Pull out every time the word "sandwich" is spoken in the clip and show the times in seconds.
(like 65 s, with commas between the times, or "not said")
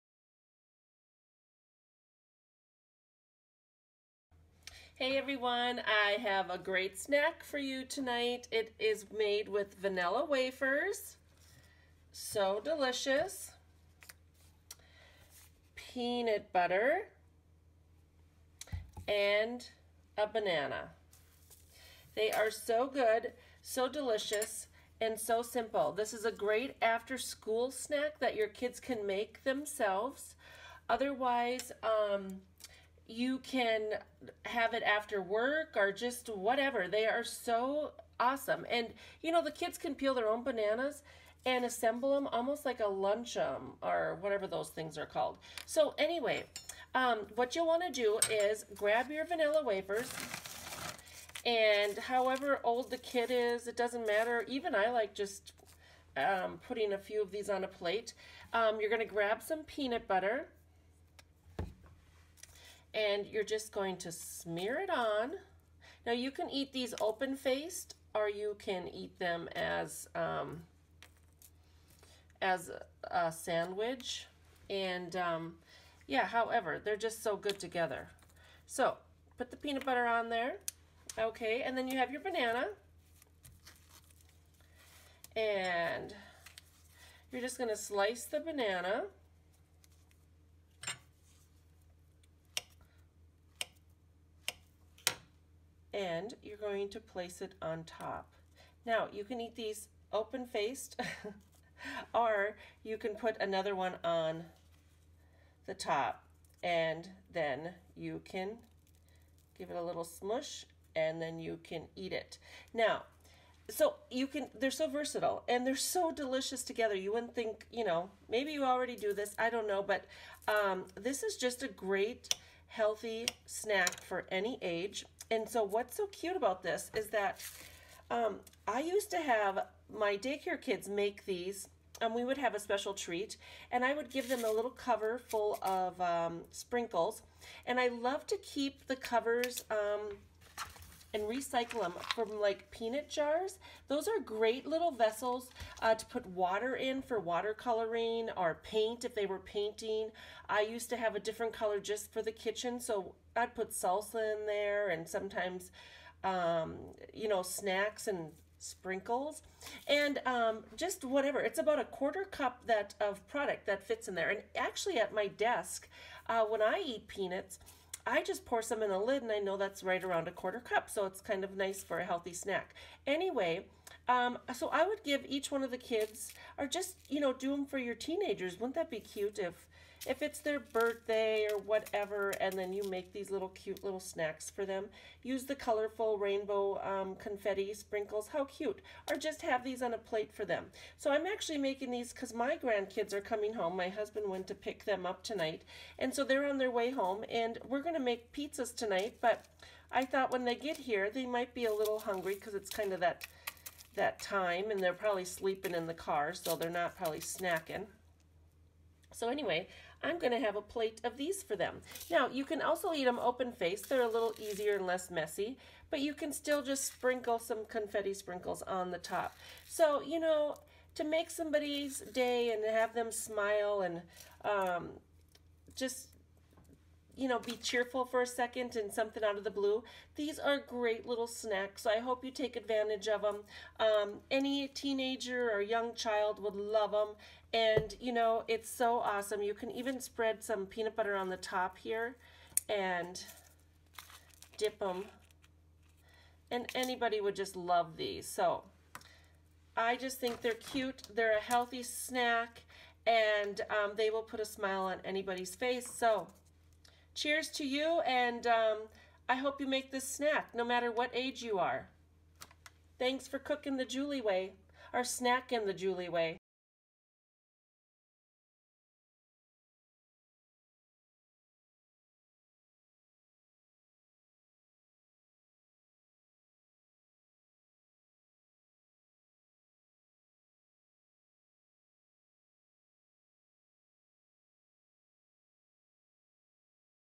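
73 s.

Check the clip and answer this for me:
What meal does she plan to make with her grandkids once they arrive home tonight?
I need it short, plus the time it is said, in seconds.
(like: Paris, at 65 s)
pizzas, at 198 s.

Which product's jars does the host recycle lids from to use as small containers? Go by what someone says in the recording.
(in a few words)
peanut jars.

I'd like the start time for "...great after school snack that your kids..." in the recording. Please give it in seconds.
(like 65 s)
26 s.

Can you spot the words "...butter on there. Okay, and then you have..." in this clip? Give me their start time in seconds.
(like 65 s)
79 s.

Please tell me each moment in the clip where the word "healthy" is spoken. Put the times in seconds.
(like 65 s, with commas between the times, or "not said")
122 s, 172 s, 251 s.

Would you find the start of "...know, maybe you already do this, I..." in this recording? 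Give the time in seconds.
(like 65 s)
117 s.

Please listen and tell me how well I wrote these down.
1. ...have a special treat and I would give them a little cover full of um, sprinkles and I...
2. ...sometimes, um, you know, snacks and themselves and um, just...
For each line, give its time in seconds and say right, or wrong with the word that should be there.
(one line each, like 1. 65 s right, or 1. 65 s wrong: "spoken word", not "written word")
1. 132 s right
2. 155 s wrong: "sprinkles", not "themselves".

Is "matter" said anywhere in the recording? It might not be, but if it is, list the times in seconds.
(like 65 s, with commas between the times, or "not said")
54 s, 260 s.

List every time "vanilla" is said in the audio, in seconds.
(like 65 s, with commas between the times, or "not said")
9 s, 49 s.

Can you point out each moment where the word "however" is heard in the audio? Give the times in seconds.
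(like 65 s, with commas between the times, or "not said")
51 s, 76 s.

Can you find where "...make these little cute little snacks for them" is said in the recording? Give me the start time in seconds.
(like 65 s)
182 s.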